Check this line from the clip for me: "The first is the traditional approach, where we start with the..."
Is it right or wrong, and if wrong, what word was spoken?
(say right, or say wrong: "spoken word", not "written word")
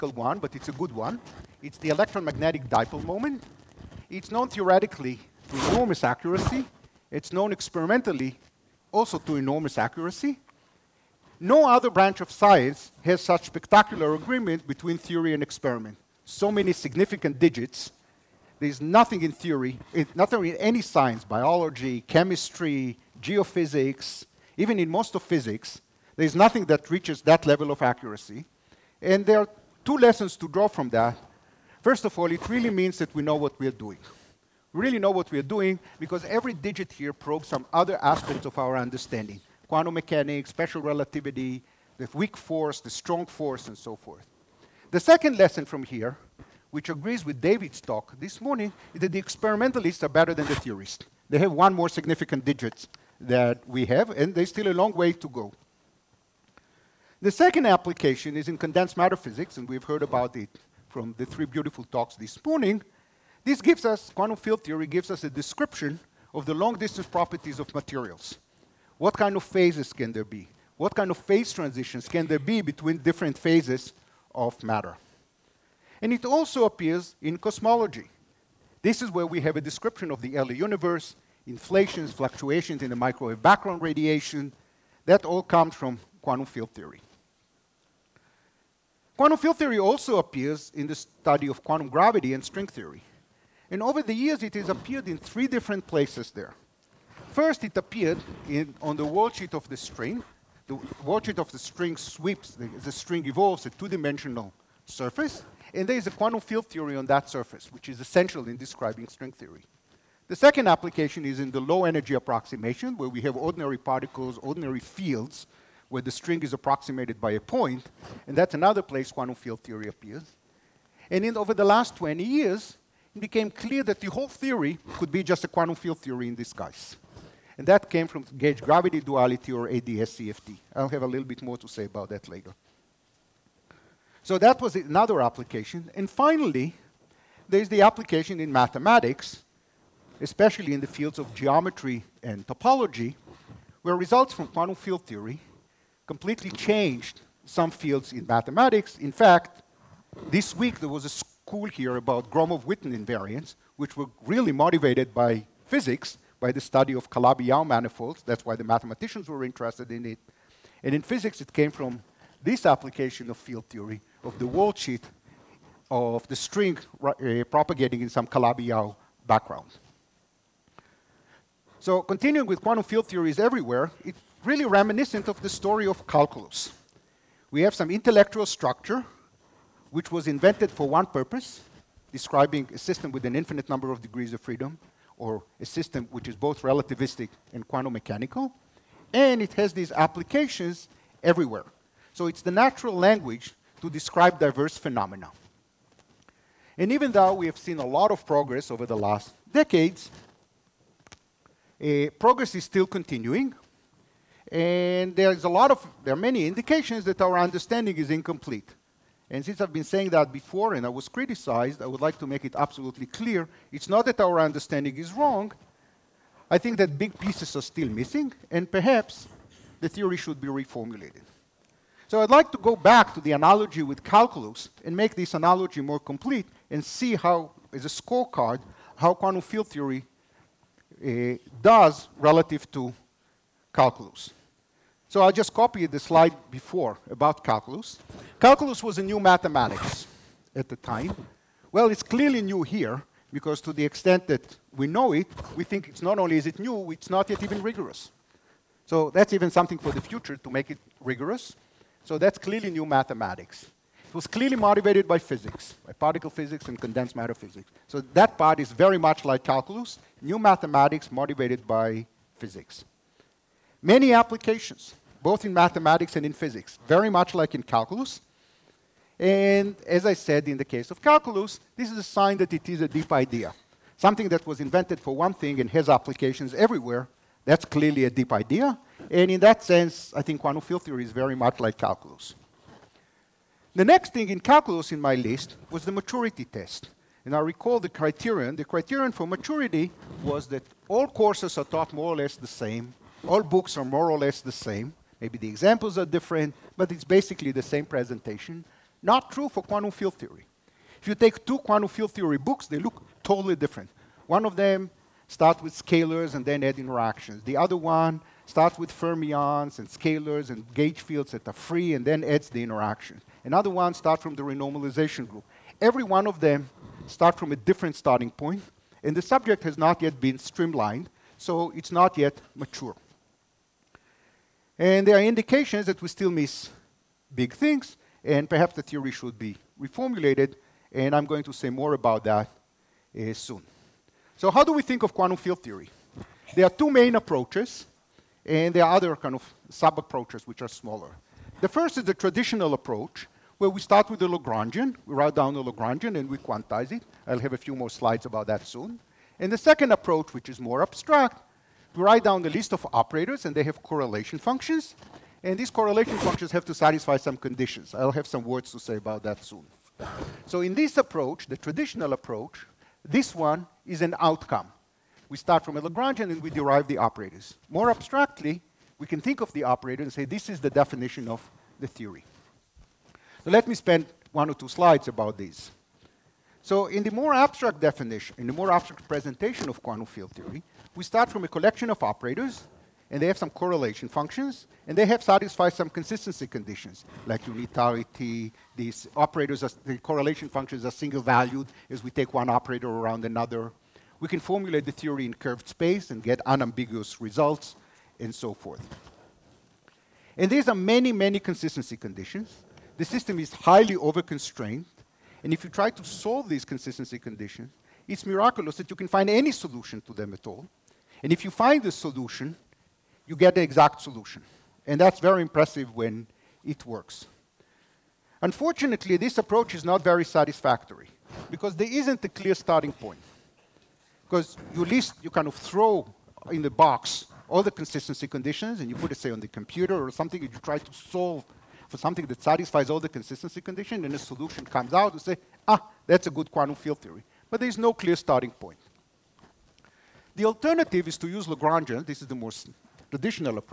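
right.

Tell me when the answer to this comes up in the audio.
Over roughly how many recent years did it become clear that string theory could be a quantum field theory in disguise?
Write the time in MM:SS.
02:01.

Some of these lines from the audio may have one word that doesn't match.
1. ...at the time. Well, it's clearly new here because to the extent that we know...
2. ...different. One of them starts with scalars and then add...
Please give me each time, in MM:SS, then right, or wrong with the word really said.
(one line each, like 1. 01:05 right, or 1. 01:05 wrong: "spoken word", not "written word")
1. 04:00 right
2. 05:03 right.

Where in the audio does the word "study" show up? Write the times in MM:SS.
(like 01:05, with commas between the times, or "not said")
01:30, 02:36.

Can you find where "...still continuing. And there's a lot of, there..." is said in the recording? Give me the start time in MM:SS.
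03:22.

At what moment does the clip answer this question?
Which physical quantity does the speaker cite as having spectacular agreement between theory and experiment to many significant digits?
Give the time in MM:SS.
00:01.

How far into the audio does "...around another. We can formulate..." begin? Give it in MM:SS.
06:32.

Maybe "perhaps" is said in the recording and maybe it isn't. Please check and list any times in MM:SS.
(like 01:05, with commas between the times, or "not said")
03:38, 05:28.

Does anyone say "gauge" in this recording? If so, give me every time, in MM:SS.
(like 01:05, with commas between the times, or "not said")
02:08, 05:10.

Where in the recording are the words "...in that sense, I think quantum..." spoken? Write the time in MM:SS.
04:39.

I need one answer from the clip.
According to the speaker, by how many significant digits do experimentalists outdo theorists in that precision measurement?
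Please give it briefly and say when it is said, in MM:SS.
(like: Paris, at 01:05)
1, at 00:51.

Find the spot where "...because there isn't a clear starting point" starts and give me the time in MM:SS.
07:01.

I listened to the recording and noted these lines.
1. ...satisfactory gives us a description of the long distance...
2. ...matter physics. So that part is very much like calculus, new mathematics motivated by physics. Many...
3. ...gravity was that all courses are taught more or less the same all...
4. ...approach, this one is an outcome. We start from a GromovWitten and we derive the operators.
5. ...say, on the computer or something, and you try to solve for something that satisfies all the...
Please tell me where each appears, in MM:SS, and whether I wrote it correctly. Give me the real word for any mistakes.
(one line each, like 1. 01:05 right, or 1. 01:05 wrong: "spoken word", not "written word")
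1. 01:04 wrong: "theory", not "satisfactory"
2. 04:17 right
3. 04:49 wrong: "maturity", not "gravity"
4. 06:02 wrong: "Lagrangian", not "GromovWitten"
5. 07:09 right.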